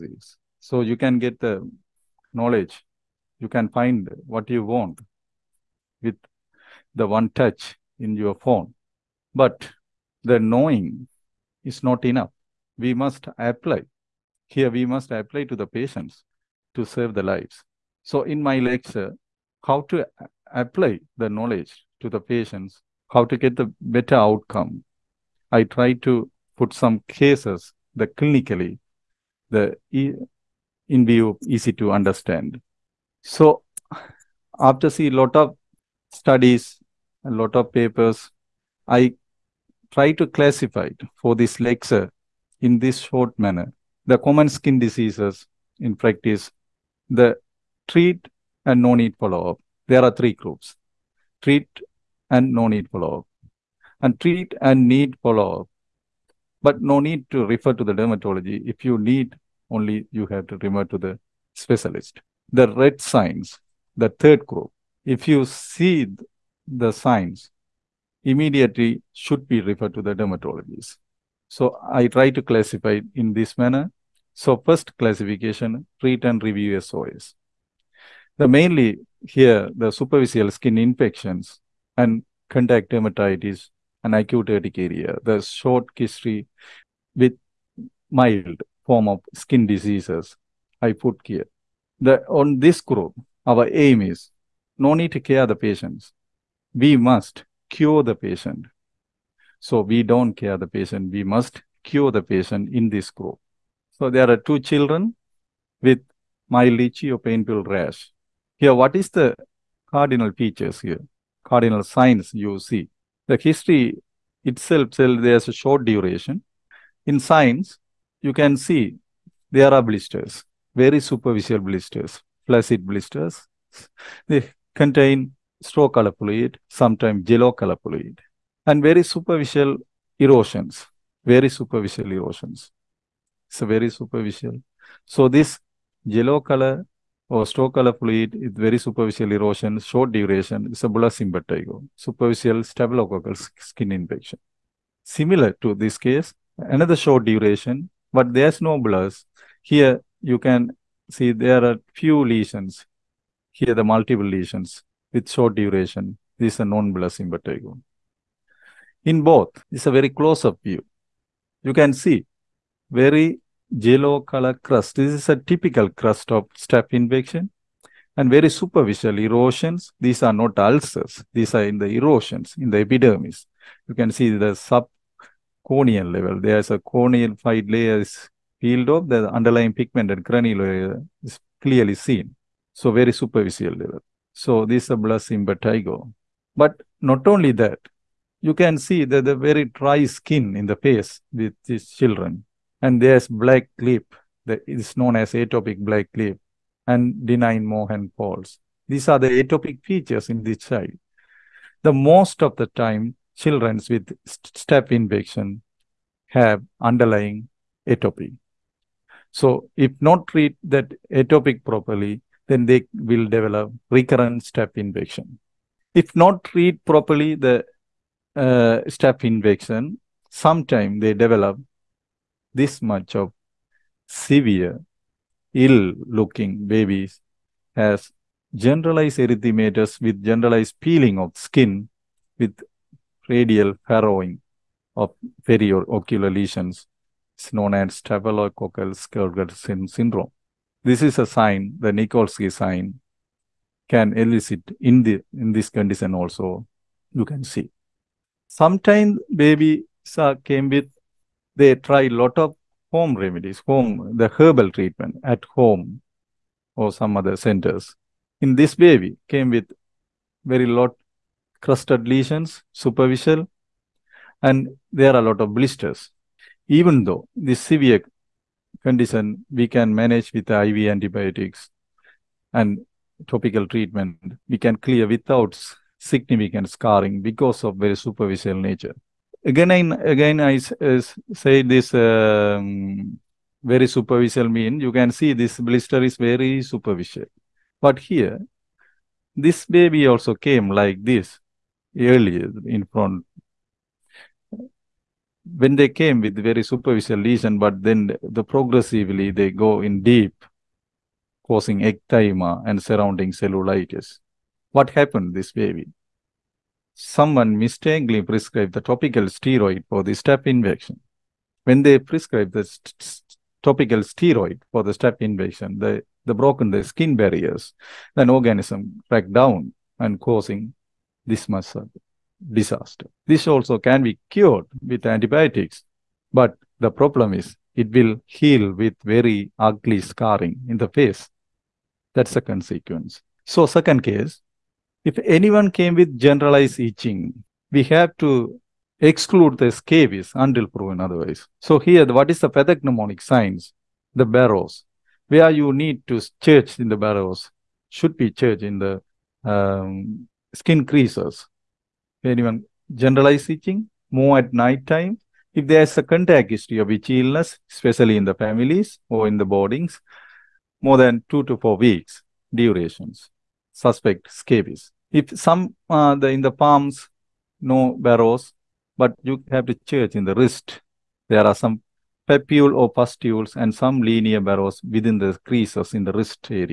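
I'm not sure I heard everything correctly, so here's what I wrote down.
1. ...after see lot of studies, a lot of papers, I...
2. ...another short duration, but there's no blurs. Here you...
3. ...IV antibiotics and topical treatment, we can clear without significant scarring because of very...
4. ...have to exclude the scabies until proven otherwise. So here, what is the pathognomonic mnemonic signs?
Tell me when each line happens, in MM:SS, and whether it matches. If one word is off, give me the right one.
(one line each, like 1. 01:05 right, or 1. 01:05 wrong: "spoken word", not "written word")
1. 00:34 right
2. 02:26 right
3. 04:30 right
4. 05:37 right.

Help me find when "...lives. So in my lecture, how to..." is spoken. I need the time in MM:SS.
00:17.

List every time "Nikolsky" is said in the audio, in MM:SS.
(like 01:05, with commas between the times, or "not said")
04:01.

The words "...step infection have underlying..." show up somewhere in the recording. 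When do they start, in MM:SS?
03:24.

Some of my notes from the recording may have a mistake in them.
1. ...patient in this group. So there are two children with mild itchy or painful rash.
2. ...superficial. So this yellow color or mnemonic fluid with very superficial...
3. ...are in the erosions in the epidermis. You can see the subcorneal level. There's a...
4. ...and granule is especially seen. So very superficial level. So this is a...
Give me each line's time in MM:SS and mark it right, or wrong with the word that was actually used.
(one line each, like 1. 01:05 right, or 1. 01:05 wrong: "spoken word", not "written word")
1. 01:42 right
2. 02:13 wrong: "stochastic", not "mnemonic"
3. 02:51 right
4. 03:00 wrong: "clearly", not "especially".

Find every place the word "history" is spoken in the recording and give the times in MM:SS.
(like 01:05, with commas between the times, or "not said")
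01:25, 01:53, 05:56.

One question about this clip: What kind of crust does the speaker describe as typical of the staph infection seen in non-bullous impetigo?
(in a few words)
yellow color crust.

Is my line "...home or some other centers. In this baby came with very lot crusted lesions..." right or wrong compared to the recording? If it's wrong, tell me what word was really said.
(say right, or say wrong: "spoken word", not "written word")
right.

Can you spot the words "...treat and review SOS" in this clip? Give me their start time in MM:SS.
01:15.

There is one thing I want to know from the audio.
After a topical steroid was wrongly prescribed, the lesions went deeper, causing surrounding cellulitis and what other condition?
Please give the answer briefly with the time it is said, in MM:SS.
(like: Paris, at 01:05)
ecthyma, at 05:01.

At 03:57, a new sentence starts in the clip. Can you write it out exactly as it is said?
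It's known as staphylococcal scalded skin syndrome.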